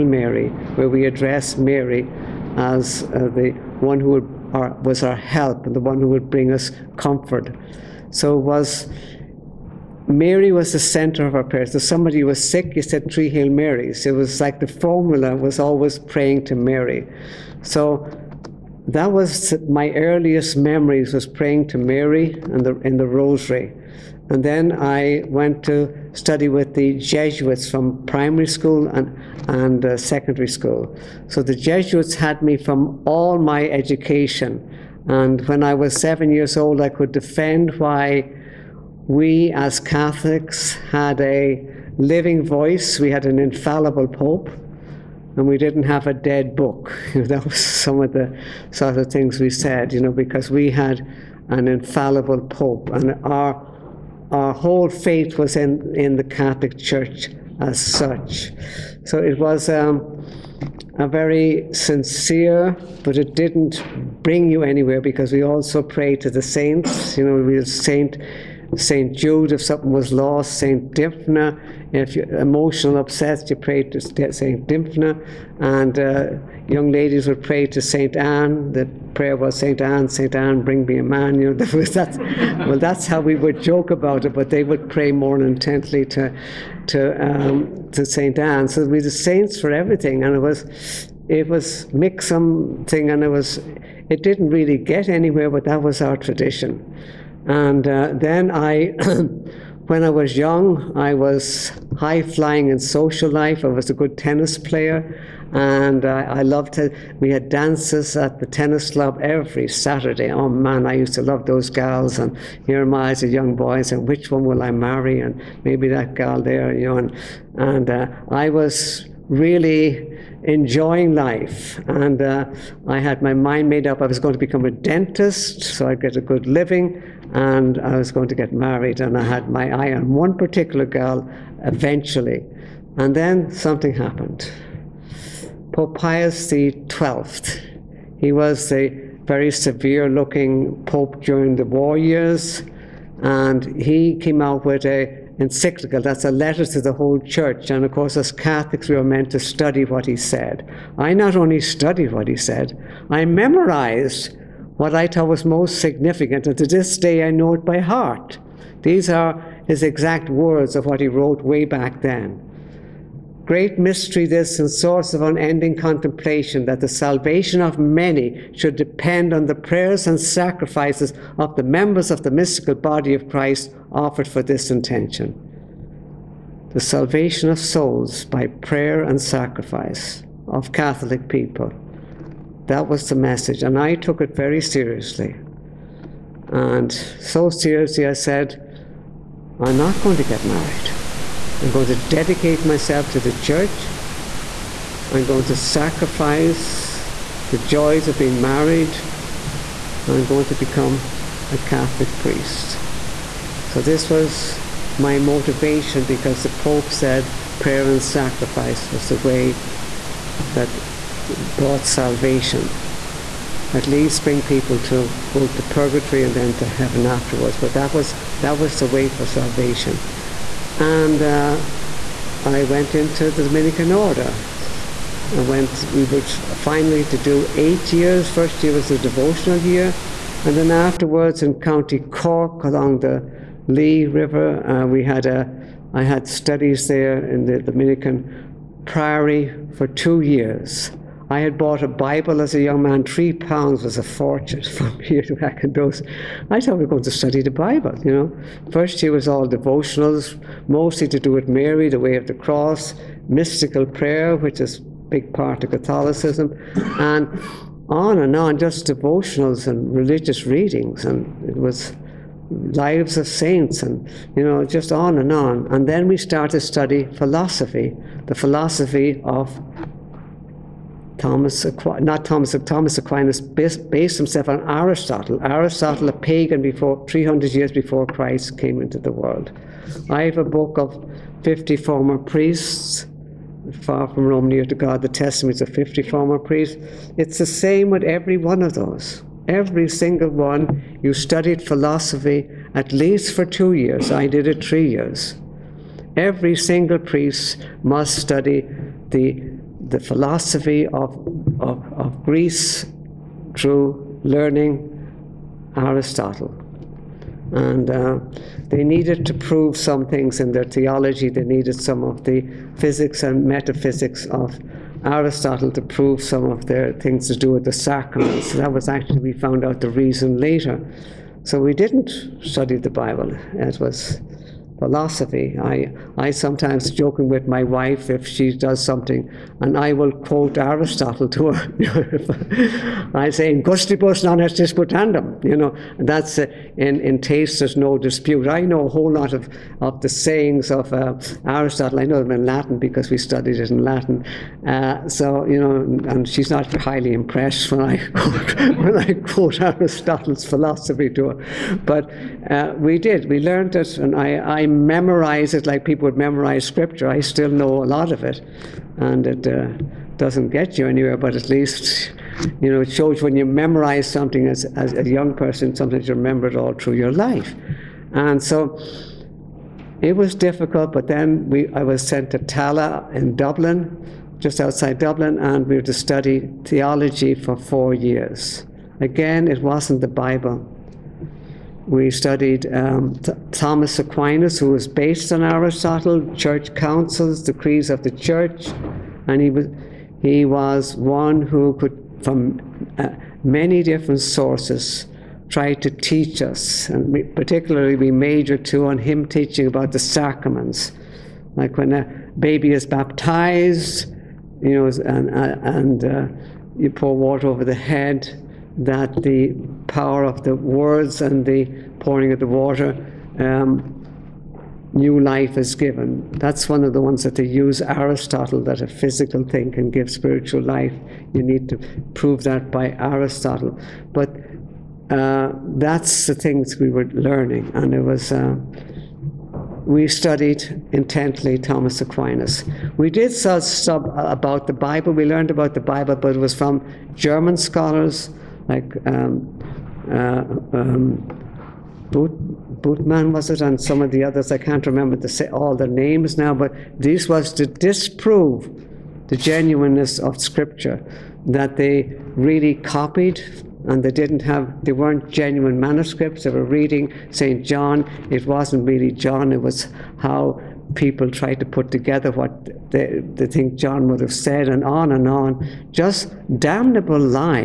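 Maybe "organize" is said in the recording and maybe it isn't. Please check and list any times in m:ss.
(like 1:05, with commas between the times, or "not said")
not said.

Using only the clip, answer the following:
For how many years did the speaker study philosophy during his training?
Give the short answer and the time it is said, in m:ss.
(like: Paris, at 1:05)
3 years, at 4:54.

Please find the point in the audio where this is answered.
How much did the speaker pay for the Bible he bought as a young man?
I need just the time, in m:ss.
4:03.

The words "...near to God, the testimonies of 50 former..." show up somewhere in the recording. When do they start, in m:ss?
4:44.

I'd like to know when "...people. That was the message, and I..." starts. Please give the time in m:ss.
3:01.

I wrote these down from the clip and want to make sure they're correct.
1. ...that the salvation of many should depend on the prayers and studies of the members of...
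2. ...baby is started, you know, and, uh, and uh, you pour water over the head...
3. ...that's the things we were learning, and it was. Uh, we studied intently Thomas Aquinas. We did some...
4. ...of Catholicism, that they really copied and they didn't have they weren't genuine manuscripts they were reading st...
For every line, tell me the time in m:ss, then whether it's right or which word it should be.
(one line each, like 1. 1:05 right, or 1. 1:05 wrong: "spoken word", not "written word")
1. 2:46 wrong: "sacrifices", not "studies"
2. 6:42 wrong: "baptized", not "started"
3. 7:05 right
4. 7:30 wrong: "Scripture", not "Catholicism".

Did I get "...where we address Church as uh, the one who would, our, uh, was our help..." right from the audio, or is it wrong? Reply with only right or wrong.
wrong.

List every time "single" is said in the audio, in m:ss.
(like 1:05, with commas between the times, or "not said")
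4:49, 4:56.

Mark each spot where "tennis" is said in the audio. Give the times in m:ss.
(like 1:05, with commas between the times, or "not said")
1:44, 1:48.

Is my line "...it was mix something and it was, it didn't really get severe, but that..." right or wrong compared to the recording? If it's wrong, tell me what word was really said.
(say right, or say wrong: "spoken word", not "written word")
wrong: "anywhere", not "severe".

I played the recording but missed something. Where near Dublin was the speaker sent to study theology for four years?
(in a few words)
Tallaght.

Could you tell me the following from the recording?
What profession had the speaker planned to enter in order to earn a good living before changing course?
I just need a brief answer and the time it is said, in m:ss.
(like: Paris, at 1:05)
Dentist, at 2:04.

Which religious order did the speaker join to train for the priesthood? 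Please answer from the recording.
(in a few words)
Dominican order.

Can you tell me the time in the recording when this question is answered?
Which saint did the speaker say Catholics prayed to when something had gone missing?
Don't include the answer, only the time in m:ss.
1:08.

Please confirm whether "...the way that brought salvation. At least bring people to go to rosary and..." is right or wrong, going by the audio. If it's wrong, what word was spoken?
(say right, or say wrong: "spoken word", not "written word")
wrong: "purgatory", not "rosary".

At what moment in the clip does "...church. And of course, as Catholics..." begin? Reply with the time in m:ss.
2:27.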